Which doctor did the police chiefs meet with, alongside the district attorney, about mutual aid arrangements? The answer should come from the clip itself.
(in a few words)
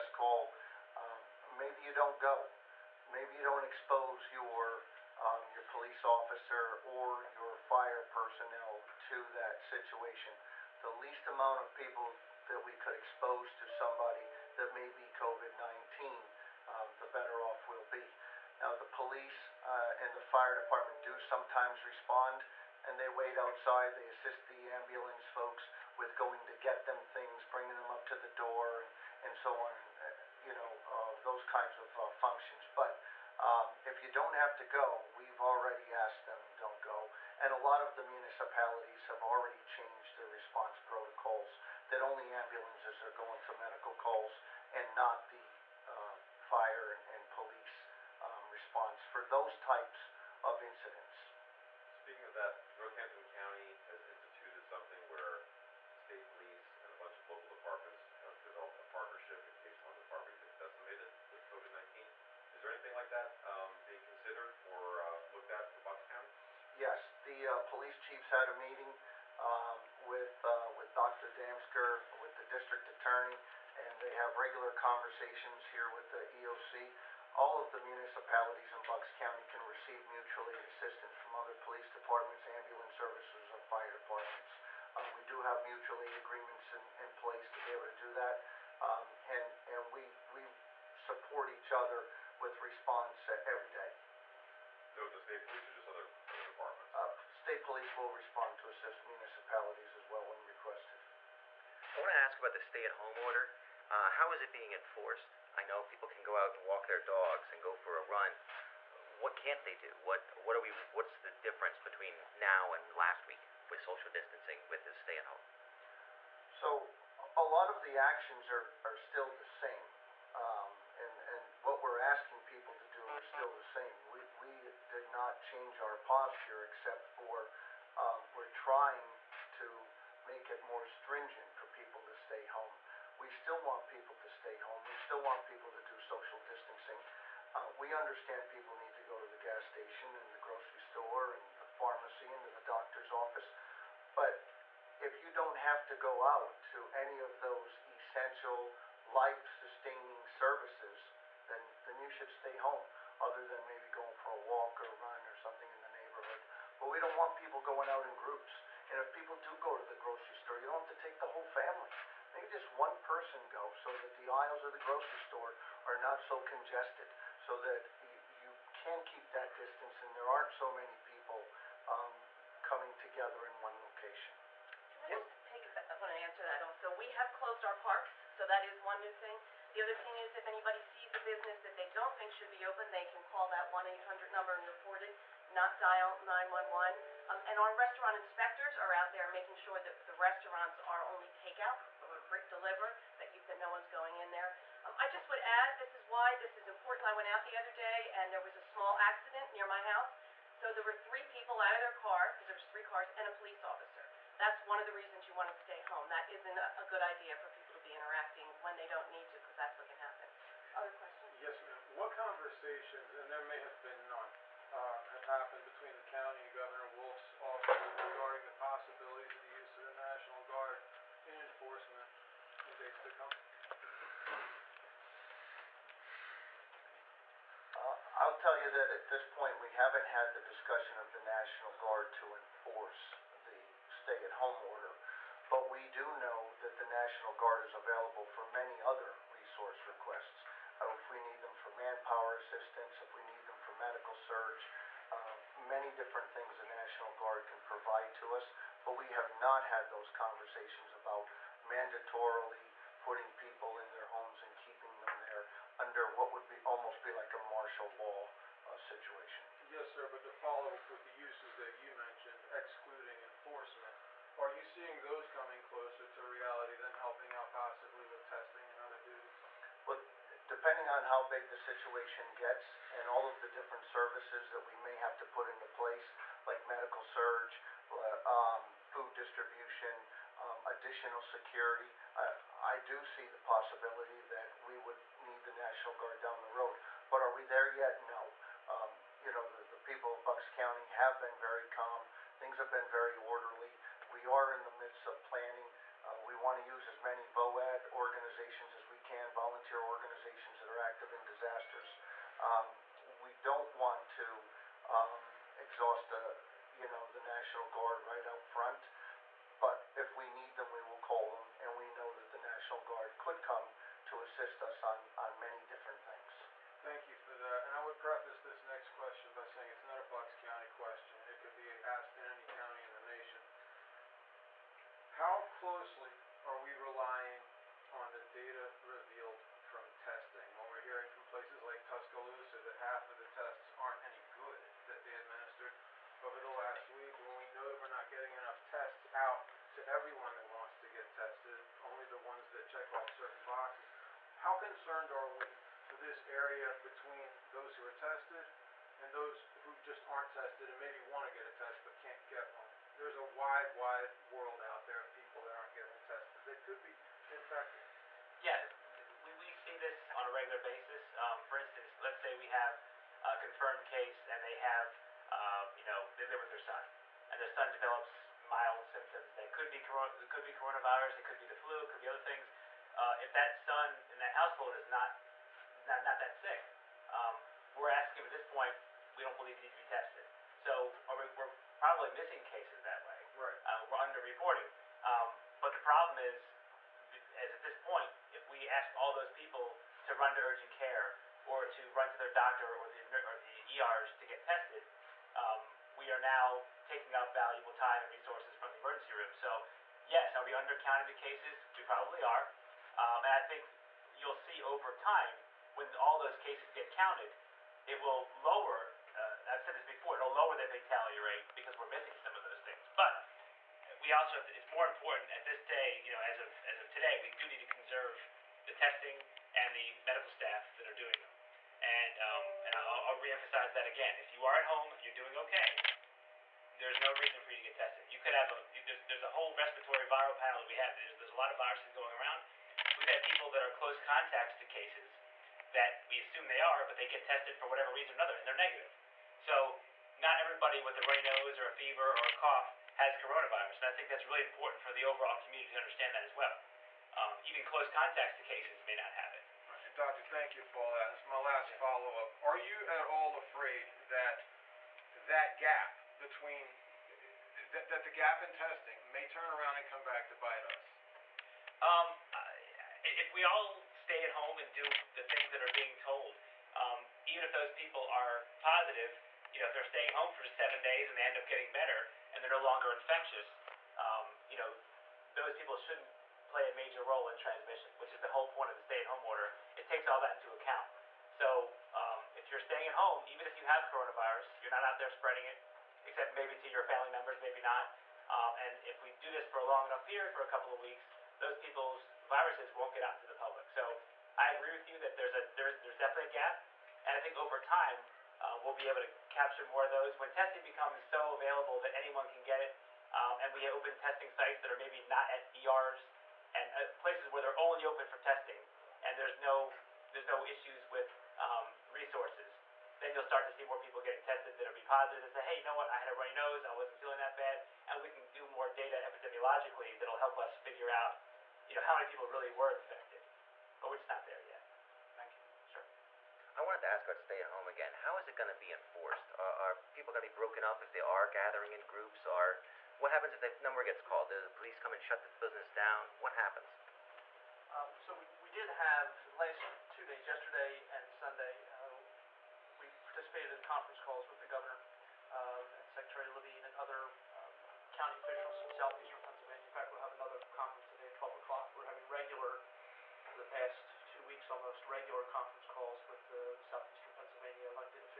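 Dr. Damsker.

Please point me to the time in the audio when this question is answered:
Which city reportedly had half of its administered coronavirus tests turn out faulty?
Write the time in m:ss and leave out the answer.
5:31.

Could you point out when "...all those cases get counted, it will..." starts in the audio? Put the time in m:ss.
6:45.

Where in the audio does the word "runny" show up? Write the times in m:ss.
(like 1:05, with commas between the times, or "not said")
7:21, 8:36.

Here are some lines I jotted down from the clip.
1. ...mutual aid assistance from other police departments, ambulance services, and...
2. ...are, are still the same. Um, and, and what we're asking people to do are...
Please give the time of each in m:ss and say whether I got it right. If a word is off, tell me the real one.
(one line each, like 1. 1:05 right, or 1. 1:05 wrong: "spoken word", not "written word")
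1. 1:20 right
2. 1:58 right.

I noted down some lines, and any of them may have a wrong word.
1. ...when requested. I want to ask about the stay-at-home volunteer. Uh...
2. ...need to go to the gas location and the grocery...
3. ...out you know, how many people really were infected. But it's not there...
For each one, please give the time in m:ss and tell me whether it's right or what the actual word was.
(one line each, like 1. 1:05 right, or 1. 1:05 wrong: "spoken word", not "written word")
1. 1:40 wrong: "order", not "volunteer"
2. 2:18 wrong: "station", not "location"
3. 8:40 right.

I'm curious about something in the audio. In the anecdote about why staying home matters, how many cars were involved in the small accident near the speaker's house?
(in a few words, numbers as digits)
3.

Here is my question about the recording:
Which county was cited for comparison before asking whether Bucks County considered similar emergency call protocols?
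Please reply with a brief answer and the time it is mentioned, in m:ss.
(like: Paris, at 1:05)
Northampton County, at 0:52.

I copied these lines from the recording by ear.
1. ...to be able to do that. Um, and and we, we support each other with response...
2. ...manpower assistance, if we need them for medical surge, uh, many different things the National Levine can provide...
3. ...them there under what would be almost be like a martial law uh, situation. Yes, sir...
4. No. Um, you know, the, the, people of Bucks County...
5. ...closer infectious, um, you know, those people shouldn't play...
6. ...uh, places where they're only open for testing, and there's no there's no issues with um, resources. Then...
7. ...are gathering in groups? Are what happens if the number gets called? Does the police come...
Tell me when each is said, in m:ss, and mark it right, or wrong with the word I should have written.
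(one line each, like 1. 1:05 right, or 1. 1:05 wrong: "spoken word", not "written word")
1. 1:27 right
2. 4:01 wrong: "Guard", not "Levine"
3. 4:15 right
4. 4:48 right
5. 7:52 wrong: "longer", not "closer"
6. 8:26 right
7. 8:51 right.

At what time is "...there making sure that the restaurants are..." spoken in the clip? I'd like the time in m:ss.
3:09.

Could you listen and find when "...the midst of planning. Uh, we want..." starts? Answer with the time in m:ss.
4:54.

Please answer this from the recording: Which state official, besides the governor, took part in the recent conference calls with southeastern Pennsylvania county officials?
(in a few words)
Secretary Levine.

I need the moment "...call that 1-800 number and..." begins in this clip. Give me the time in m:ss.
3:03.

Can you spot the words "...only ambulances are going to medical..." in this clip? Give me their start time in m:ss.
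0:42.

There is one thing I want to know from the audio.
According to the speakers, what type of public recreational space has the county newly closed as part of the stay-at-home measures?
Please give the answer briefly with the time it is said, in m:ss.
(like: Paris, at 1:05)
parks, at 2:57.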